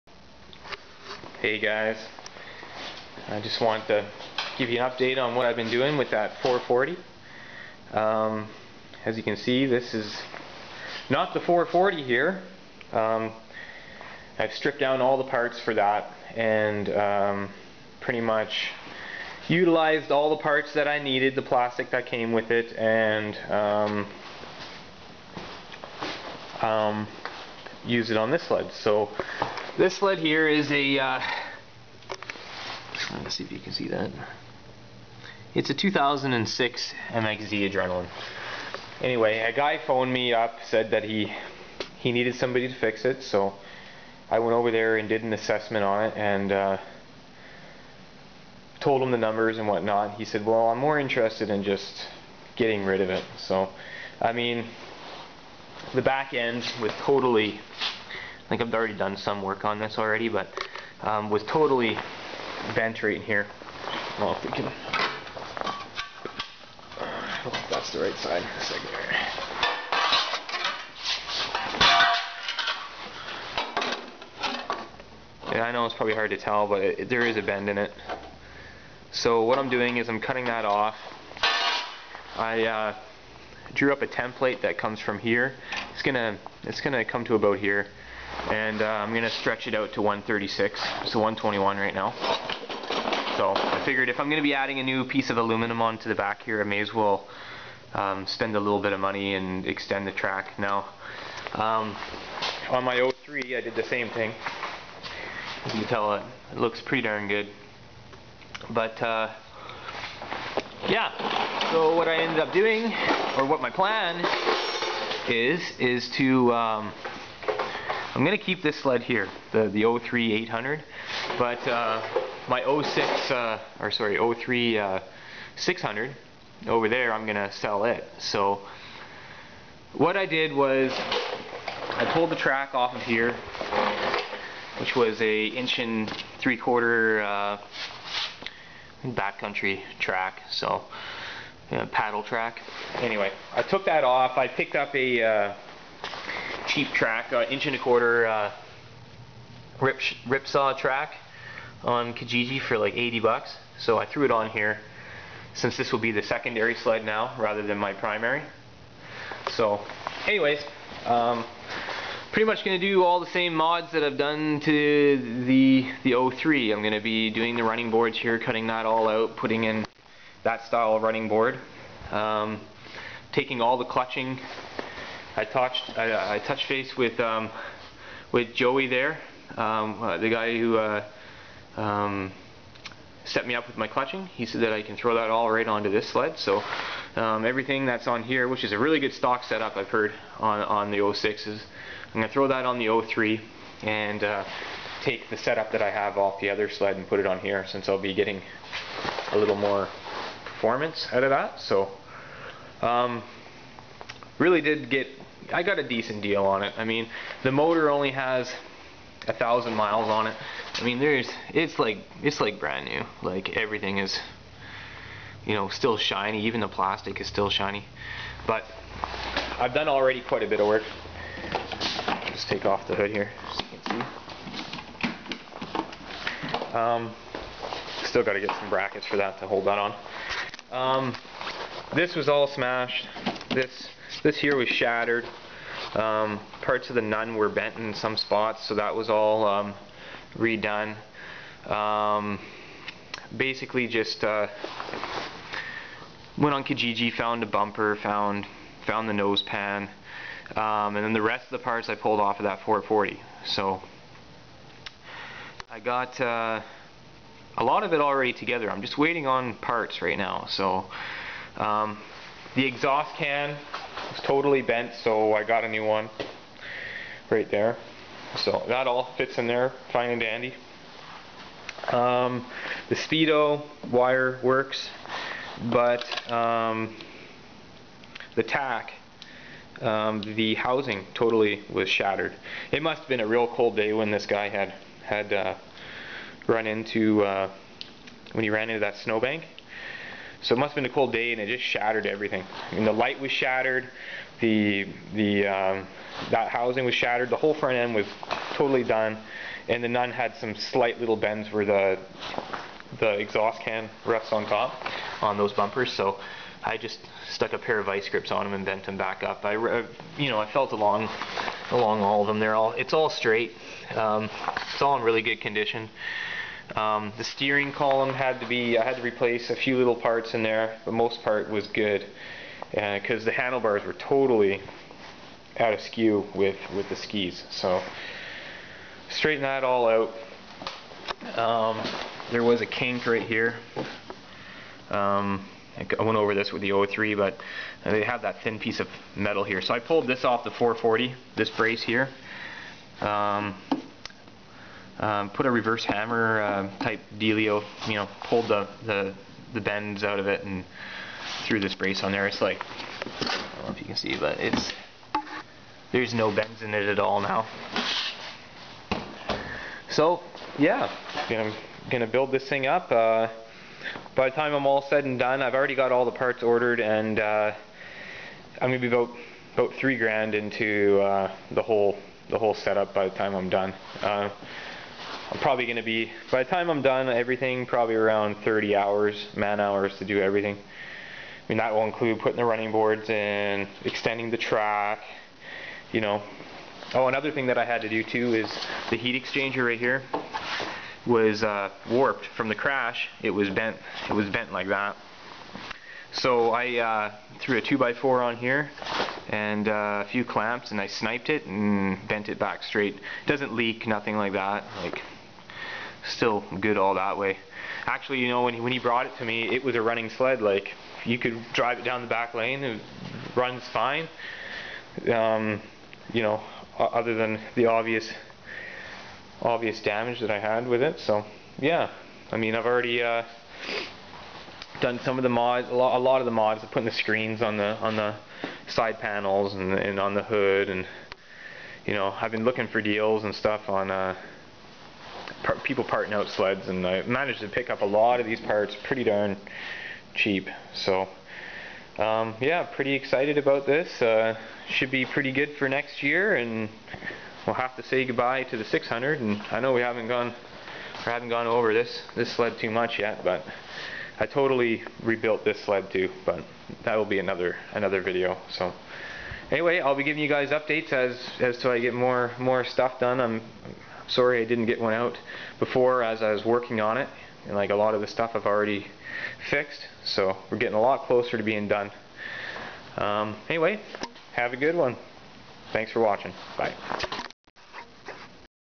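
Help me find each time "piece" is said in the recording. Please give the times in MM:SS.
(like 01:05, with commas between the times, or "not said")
01:35, 05:38.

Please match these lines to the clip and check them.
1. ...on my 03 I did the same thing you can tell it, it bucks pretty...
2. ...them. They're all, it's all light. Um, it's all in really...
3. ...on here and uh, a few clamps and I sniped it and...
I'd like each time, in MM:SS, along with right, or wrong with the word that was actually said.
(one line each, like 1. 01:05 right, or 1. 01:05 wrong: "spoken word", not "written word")
1. 01:42 wrong: "looks", not "bucks"
2. 05:12 wrong: "straight", not "light"
3. 06:38 right.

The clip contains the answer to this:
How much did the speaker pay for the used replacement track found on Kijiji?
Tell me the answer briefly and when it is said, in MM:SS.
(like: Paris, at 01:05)
80 bucks, at 02:32.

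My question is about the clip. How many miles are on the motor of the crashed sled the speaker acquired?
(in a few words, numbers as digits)
1000 miles.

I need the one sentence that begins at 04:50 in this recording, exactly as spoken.
So it must have been a cold day, and it just shattered everything.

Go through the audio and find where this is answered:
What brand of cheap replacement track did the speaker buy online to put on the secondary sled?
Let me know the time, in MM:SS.
02:29.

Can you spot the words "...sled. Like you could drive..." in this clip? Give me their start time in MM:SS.
06:50.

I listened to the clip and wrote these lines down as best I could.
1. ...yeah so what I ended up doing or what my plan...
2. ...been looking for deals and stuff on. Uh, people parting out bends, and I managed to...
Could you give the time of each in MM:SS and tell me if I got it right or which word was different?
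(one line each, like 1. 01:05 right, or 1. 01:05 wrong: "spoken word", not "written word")
1. 01:50 right
2. 07:12 wrong: "sleds", not "bends".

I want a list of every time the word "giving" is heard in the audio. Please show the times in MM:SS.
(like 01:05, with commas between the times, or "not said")
07:40.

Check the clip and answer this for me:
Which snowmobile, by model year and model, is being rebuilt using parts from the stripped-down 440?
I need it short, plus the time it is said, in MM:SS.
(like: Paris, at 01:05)
2006 MXZ Adrenaline, at 00:35.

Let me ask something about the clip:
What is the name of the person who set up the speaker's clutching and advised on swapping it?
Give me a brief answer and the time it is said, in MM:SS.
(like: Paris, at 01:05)
Joey, at 02:58.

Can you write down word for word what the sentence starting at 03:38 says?
But I've done already quite a bit of work.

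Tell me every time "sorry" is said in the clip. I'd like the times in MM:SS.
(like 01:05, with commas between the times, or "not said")
02:03, 07:44.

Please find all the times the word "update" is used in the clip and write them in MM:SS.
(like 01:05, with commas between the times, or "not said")
00:04, 07:40.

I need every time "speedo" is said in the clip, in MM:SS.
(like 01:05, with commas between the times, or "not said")
04:32.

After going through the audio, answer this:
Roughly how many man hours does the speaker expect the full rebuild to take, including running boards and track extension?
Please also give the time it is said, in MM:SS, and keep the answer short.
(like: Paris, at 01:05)
30 hours, at 06:18.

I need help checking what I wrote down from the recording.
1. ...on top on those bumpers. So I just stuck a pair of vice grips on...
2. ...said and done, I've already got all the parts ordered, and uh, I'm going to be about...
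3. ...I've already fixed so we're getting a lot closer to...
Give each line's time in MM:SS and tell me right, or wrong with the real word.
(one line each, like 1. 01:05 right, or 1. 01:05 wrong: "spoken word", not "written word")
1. 05:04 right
2. 06:04 right
3. 07:48 right.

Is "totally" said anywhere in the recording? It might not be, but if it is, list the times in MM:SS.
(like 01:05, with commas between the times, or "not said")
00:57, 01:01, 04:24, 04:41, 04:58, 05:23, 07:34.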